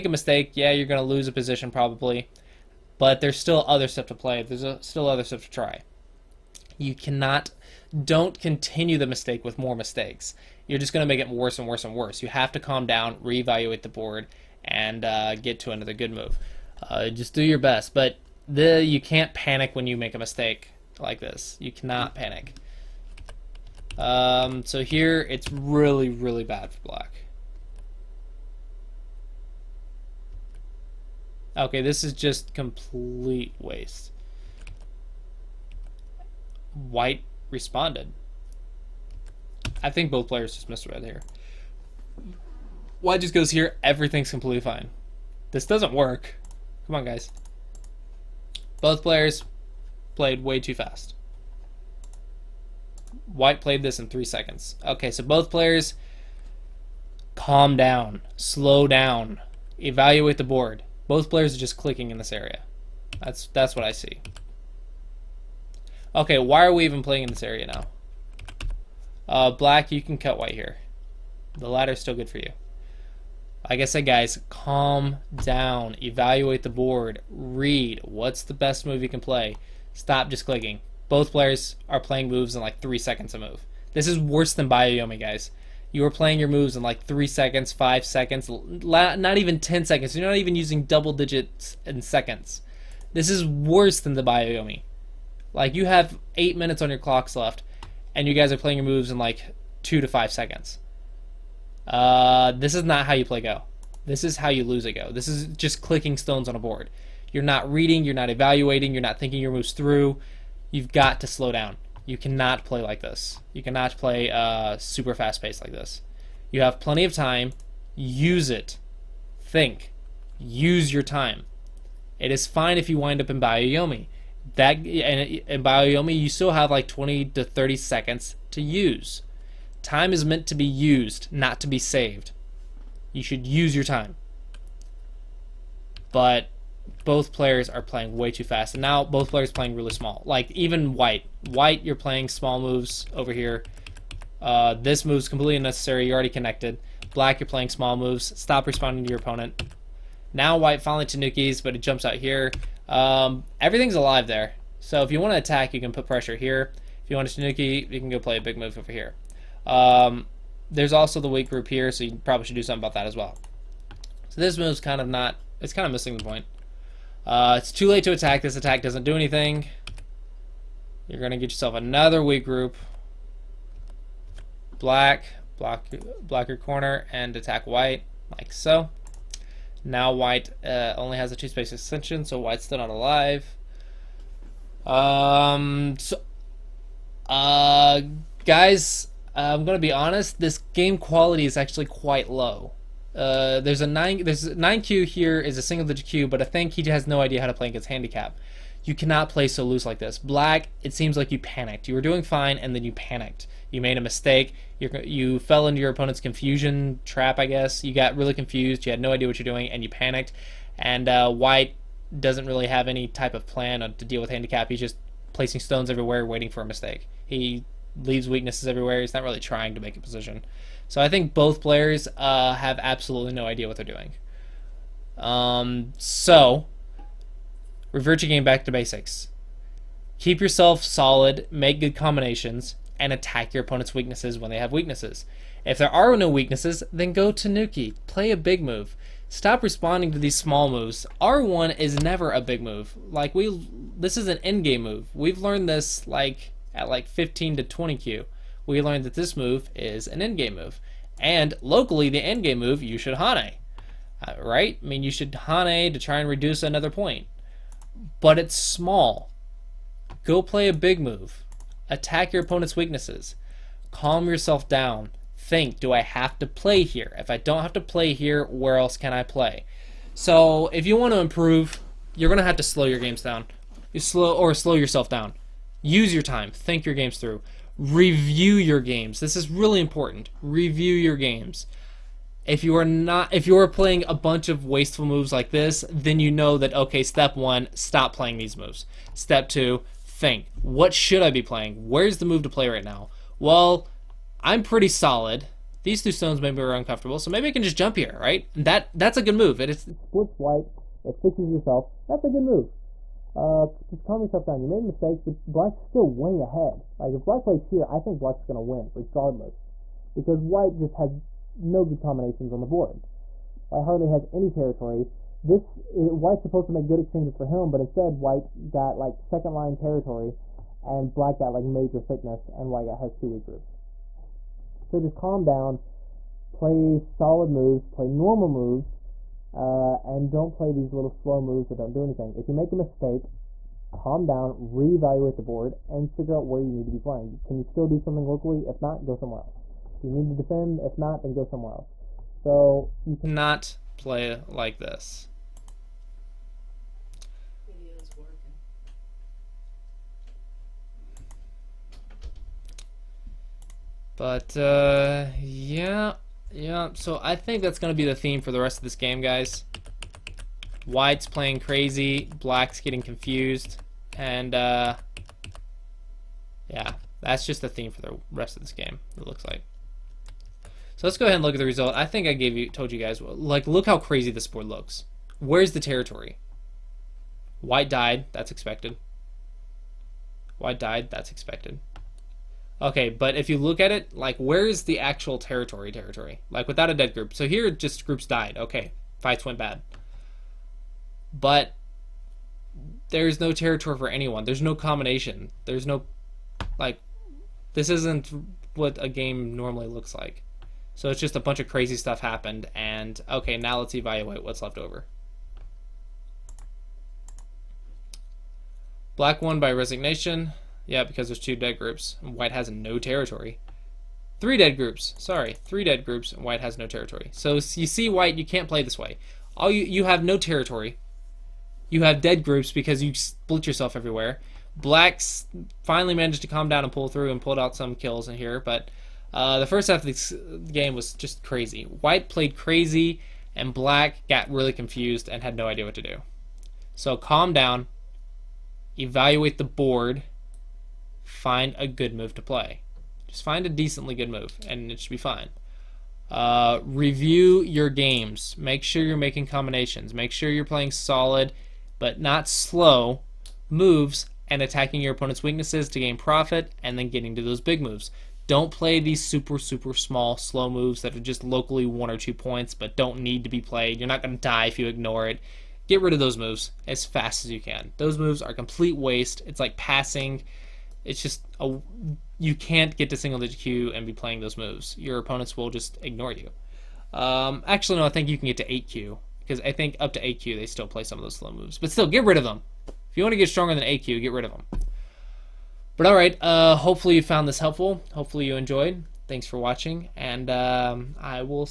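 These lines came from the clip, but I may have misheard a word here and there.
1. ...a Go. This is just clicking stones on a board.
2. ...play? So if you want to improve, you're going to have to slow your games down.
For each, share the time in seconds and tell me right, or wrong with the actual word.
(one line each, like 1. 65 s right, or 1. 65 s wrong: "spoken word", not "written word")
1. 104 s right
2. 269 s right.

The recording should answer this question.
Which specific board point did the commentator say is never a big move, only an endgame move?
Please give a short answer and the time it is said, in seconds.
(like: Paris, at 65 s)
R1, at 241 s.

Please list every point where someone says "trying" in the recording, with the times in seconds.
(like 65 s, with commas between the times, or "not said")
219 s.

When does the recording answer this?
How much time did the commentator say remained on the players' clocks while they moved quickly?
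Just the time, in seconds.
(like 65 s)
96 s.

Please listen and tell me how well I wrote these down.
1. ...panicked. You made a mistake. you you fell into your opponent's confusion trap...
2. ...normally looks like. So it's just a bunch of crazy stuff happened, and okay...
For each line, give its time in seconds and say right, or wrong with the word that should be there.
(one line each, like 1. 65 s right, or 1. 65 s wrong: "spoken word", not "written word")
1. 202 s right
2. 399 s right.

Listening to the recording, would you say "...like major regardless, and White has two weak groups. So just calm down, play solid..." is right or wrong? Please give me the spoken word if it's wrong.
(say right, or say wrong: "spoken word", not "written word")
wrong: "thickness", not "regardless".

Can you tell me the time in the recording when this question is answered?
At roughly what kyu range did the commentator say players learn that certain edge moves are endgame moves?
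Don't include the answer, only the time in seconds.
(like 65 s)
247 s.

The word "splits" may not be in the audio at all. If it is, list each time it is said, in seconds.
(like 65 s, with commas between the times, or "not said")
299 s, 423 s.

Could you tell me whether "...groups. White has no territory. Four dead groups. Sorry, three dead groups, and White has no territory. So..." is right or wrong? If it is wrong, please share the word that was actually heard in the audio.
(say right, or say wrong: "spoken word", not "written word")
wrong: "Three", not "Four".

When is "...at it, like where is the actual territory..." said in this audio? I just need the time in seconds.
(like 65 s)
383 s.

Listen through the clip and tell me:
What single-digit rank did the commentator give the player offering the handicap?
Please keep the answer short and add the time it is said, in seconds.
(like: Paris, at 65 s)
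9 kyu, at 194 s.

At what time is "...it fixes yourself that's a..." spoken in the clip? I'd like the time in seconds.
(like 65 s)
301 s.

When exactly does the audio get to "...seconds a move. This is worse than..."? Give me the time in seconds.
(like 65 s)
82 s.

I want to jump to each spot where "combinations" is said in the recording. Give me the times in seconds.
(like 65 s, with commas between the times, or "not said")
231 s, 311 s, 394 s, 449 s.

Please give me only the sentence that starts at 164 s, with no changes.
So this move's kind of not, it's kind of missing the point.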